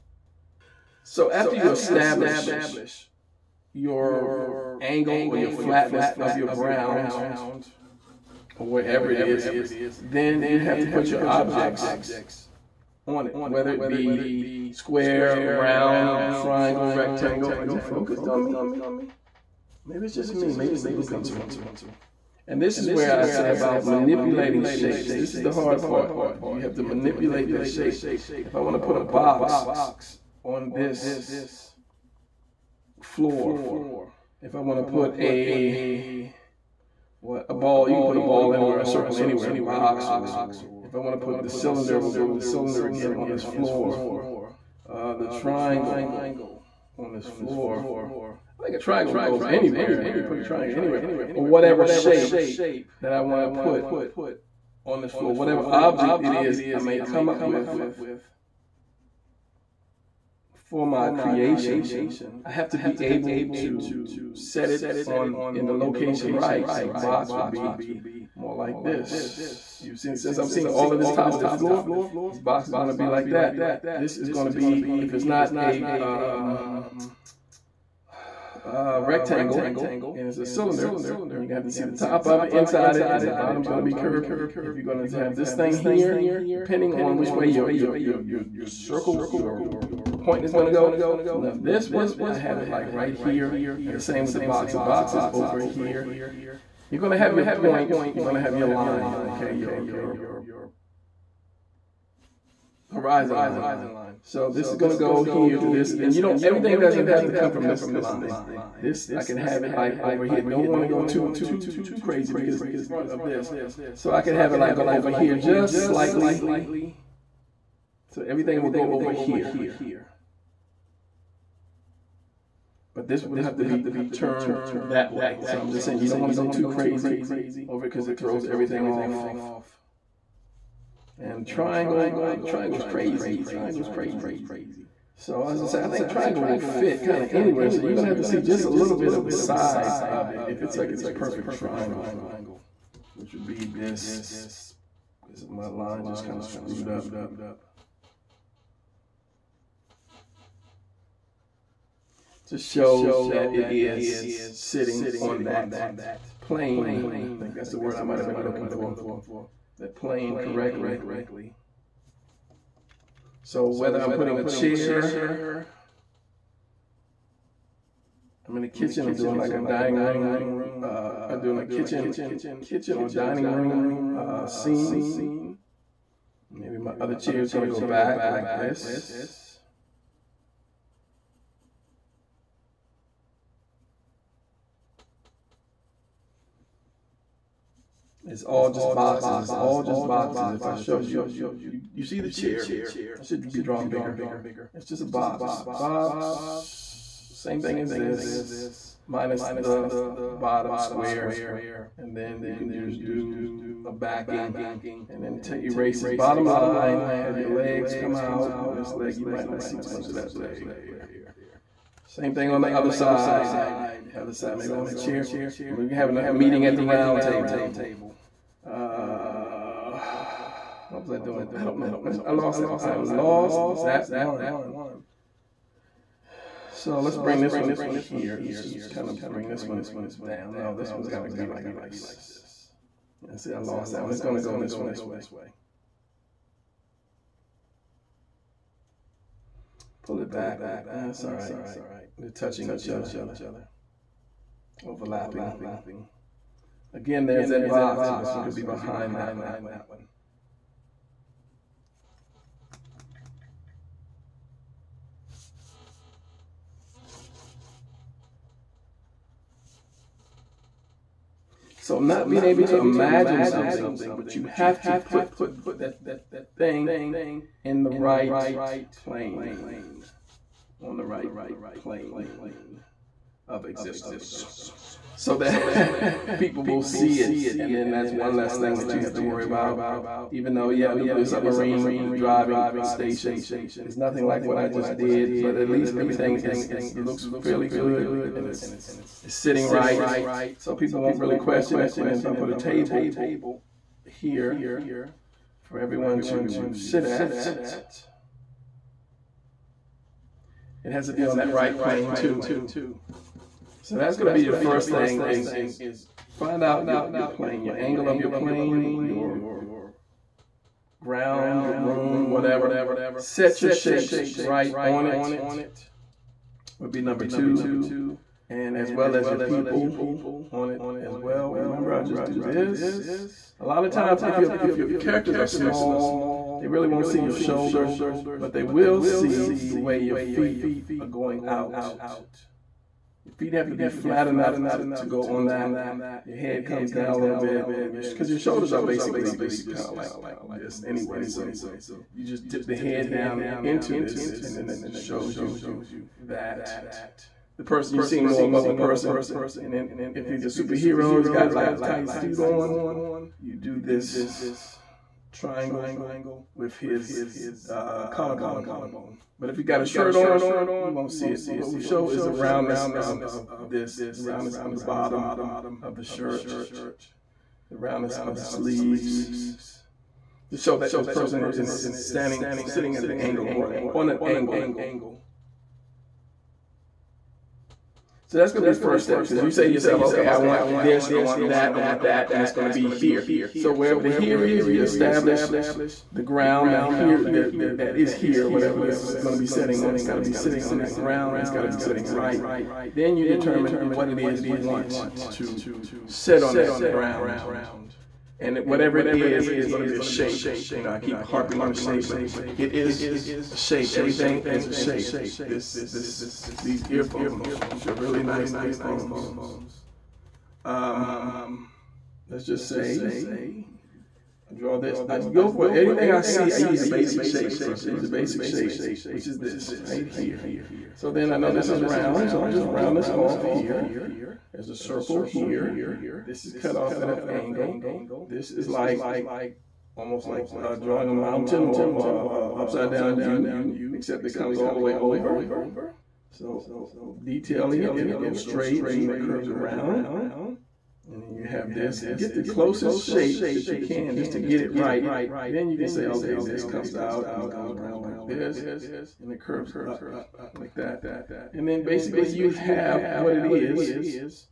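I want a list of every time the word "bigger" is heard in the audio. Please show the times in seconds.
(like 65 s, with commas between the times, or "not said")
193 s.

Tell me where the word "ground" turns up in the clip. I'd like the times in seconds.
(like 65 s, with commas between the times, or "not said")
6 s, 310 s, 386 s, 390 s, 396 s.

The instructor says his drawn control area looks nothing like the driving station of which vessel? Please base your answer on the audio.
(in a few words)
nuclear submarine.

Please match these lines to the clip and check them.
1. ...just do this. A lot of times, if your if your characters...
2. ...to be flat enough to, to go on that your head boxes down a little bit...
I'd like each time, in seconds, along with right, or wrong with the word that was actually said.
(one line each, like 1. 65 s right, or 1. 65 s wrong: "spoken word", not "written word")
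1. 322 s right
2. 333 s wrong: "comes", not "boxes".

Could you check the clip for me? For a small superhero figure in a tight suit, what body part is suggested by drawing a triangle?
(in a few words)
collarbone.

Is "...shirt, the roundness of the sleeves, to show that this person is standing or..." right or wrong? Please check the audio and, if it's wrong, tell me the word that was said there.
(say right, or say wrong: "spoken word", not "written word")
right.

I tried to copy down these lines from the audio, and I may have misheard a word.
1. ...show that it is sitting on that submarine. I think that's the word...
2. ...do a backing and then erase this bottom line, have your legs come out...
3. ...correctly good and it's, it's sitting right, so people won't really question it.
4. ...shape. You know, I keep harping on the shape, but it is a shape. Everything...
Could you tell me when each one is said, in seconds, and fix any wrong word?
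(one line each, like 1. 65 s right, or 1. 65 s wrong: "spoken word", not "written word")
1. 152 s wrong: "plane", not "submarine"
2. 203 s right
3. 287 s wrong: "fairly", not "correctly"
4. 400 s right.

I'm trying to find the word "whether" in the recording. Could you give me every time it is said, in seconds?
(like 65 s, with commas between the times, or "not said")
13 s, 163 s.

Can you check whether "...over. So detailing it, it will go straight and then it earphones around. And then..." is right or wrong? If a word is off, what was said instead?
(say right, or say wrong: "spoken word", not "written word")
wrong: "curves", not "earphones".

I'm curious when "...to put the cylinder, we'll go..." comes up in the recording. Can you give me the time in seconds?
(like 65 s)
41 s.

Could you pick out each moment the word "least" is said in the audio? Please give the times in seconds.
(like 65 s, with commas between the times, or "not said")
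285 s.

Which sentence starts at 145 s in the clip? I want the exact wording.
Because my line just kind of screwed up.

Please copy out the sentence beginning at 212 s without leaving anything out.
Same thing on the other side.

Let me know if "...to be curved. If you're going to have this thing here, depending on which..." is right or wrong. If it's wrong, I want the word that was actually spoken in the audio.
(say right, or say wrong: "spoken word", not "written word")
right.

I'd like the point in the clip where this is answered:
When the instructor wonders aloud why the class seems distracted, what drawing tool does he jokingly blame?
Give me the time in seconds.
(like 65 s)
20 s.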